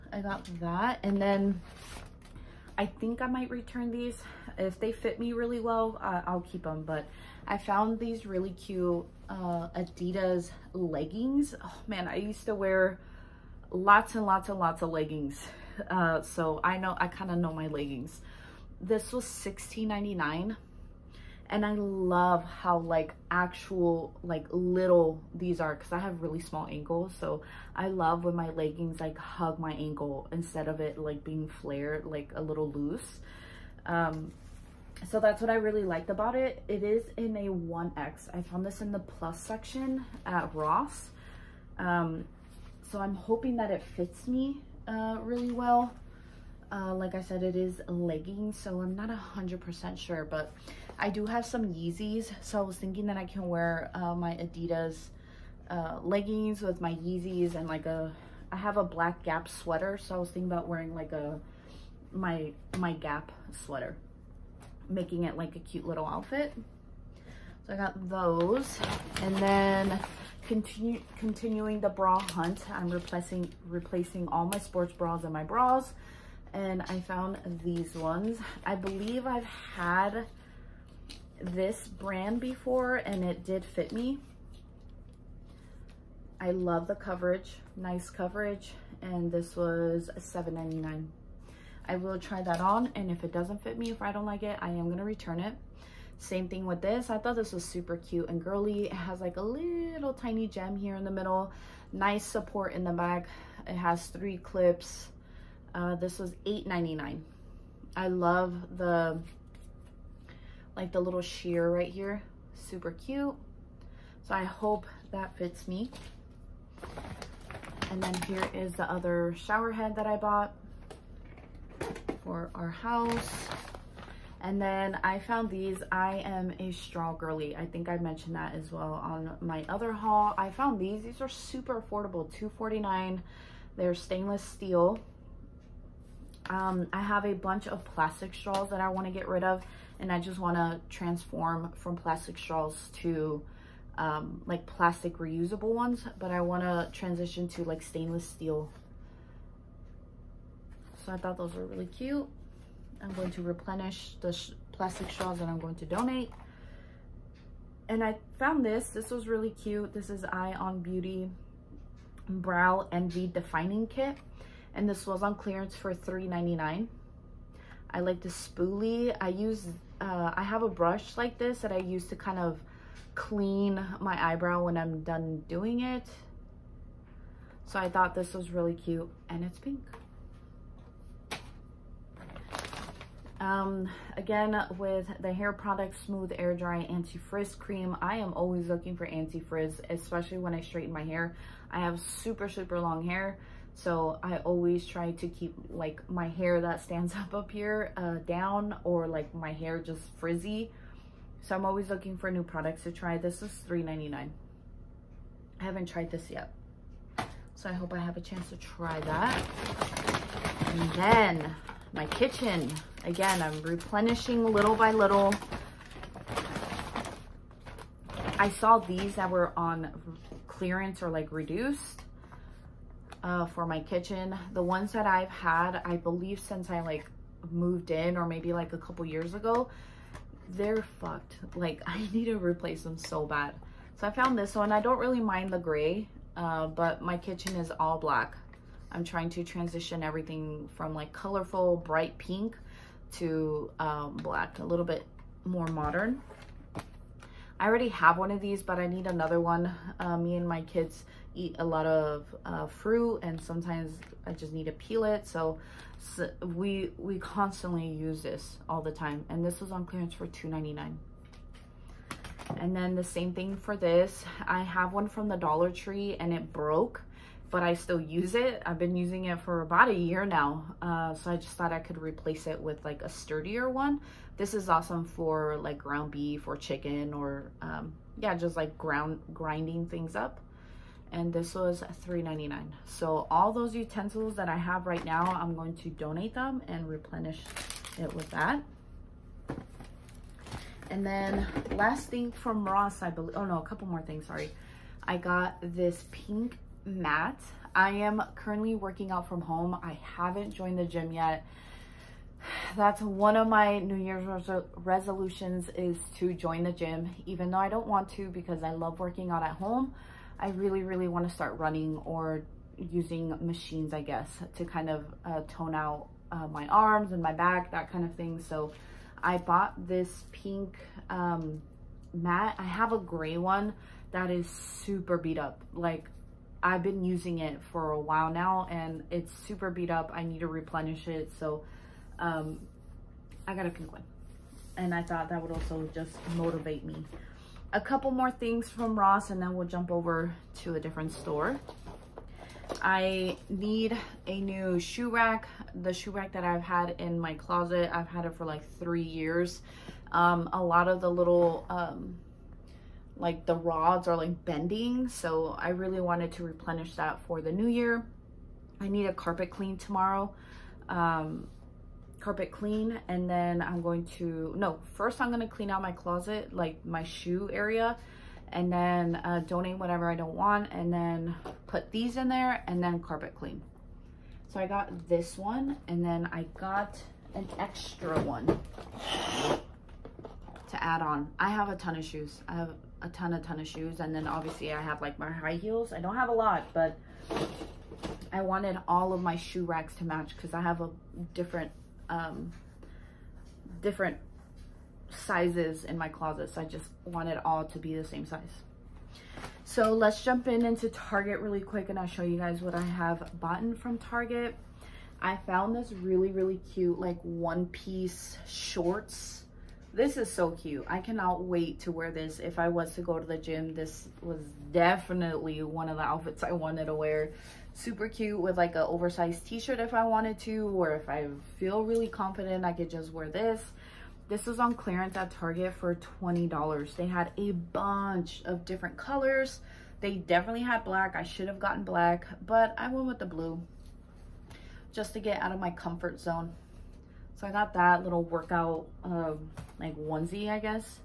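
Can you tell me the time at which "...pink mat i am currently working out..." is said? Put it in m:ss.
4:56.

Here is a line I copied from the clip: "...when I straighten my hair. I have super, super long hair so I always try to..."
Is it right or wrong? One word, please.
right.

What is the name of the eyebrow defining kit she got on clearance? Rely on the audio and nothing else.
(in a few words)
Brow Envy.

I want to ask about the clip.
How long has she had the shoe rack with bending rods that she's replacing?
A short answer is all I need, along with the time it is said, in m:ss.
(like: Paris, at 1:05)
3 years, at 5:48.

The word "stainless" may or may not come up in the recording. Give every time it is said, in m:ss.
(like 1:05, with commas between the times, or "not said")
2:13, 2:27.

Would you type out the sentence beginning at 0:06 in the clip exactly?
But I found these really cute uh, Adidas leggings.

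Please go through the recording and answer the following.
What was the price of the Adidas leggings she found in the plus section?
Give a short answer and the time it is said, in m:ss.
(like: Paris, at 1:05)
$16.99, at 0:19.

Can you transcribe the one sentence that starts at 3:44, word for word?
The ones that I've had, I believe since I like moved in or maybe like a couple years ago, they're fucked.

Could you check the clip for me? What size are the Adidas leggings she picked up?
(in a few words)
1X.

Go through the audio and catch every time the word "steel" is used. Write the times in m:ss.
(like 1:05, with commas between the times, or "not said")
2:14, 2:28.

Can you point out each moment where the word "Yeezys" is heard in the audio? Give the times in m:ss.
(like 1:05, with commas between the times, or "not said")
0:51, 0:56.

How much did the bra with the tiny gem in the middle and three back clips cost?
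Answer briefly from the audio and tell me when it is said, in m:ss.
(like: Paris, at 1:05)
$8.99, at 1:46.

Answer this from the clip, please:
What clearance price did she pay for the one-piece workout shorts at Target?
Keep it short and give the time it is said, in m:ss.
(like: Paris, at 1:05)
$20, at 7:06.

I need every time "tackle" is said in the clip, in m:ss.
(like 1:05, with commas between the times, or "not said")
not said.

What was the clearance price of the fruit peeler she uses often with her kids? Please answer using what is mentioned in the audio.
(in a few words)
$2.99.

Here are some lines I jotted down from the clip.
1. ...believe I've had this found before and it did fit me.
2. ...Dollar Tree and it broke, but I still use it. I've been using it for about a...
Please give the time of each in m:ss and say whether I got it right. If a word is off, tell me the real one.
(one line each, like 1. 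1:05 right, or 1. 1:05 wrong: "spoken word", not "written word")
1. 1:18 wrong: "brand", not "found"
2. 4:25 right.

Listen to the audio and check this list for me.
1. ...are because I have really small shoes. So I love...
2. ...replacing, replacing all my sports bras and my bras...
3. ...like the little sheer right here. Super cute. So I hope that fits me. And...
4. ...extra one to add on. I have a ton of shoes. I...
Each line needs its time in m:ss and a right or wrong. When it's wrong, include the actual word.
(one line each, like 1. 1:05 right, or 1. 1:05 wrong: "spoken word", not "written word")
1. 0:25 wrong: "ankles", not "shoes"
2. 1:12 right
3. 1:50 right
4. 6:17 right.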